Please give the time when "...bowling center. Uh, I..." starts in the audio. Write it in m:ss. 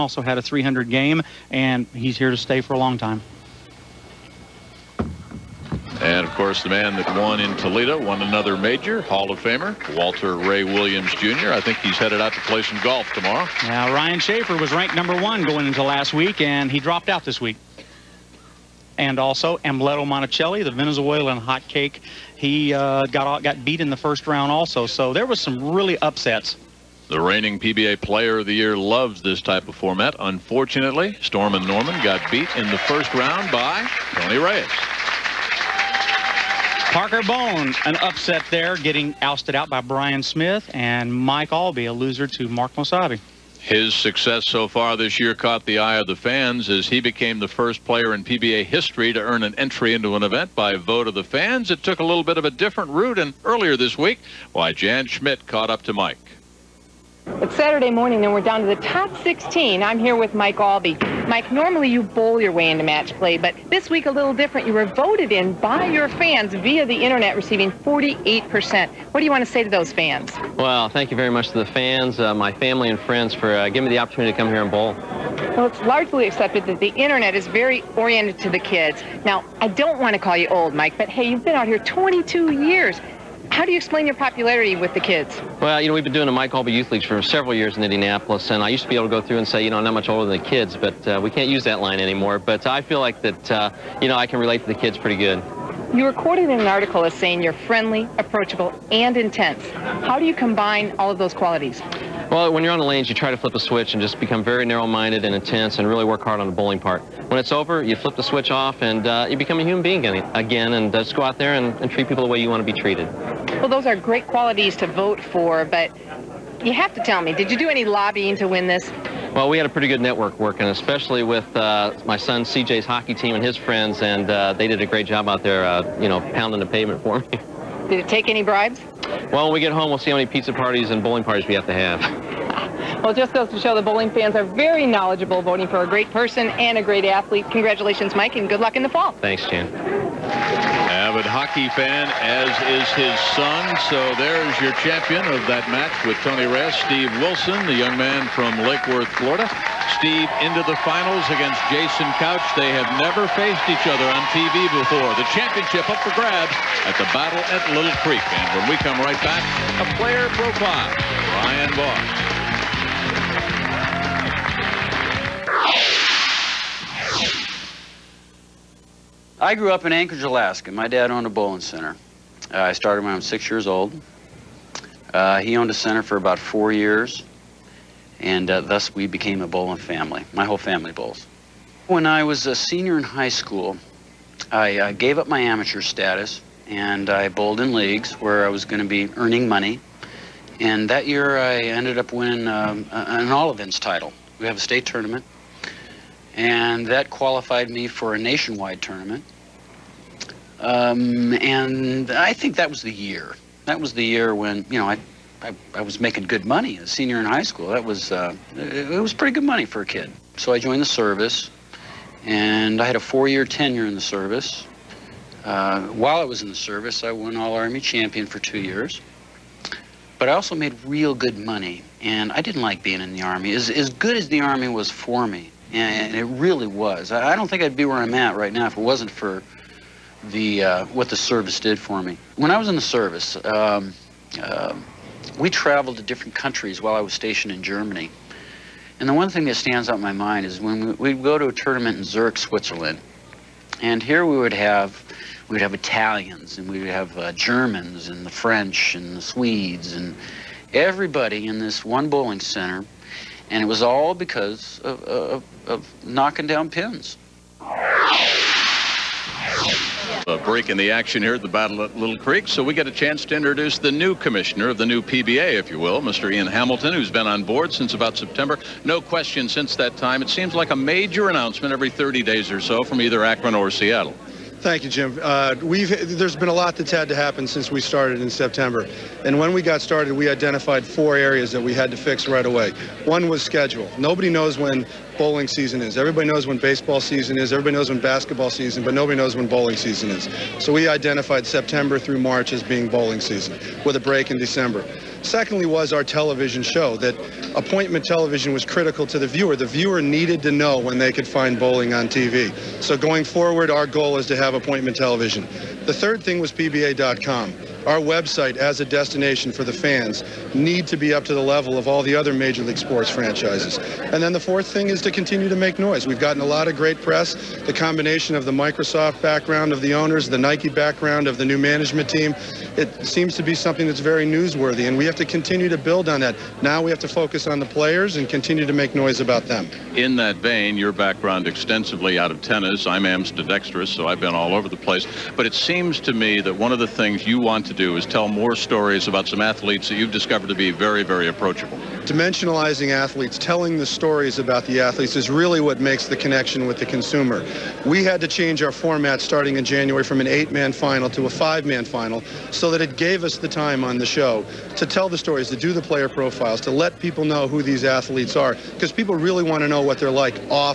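2:51.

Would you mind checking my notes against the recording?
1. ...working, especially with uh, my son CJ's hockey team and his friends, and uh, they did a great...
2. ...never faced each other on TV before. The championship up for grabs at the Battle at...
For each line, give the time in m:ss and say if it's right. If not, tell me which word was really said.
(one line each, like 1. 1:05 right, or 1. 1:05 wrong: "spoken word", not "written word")
1. 2:00 right
2. 2:33 right.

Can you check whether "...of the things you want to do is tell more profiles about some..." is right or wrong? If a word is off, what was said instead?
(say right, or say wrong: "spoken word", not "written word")
wrong: "stories", not "profiles".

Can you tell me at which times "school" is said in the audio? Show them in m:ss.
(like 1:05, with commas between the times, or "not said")
3:03, 3:27.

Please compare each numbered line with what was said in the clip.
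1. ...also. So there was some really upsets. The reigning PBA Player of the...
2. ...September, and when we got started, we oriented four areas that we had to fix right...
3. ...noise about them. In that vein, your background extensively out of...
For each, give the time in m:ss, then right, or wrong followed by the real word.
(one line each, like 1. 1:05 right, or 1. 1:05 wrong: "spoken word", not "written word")
1. 0:24 right
2. 4:38 wrong: "identified", not "oriented"
3. 5:28 right.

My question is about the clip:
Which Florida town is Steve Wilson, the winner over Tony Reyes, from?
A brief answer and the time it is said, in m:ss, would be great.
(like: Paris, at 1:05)
Lake Worth, at 2:28.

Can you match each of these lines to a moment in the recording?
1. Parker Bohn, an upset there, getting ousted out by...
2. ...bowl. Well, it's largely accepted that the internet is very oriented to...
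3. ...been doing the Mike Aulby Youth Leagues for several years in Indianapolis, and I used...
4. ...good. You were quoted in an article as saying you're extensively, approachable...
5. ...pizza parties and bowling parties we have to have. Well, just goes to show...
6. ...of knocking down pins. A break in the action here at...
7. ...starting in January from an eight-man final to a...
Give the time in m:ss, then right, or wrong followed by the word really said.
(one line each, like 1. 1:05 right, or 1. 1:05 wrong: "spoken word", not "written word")
1. 0:36 right
2. 1:14 right
3. 1:26 right
4. 1:35 wrong: "friendly", not "extensively"
5. 2:10 right
6. 4:15 right
7. 5:49 right.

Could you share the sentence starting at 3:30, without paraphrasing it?
So I joined the service, and I had a four-year tenure in the service.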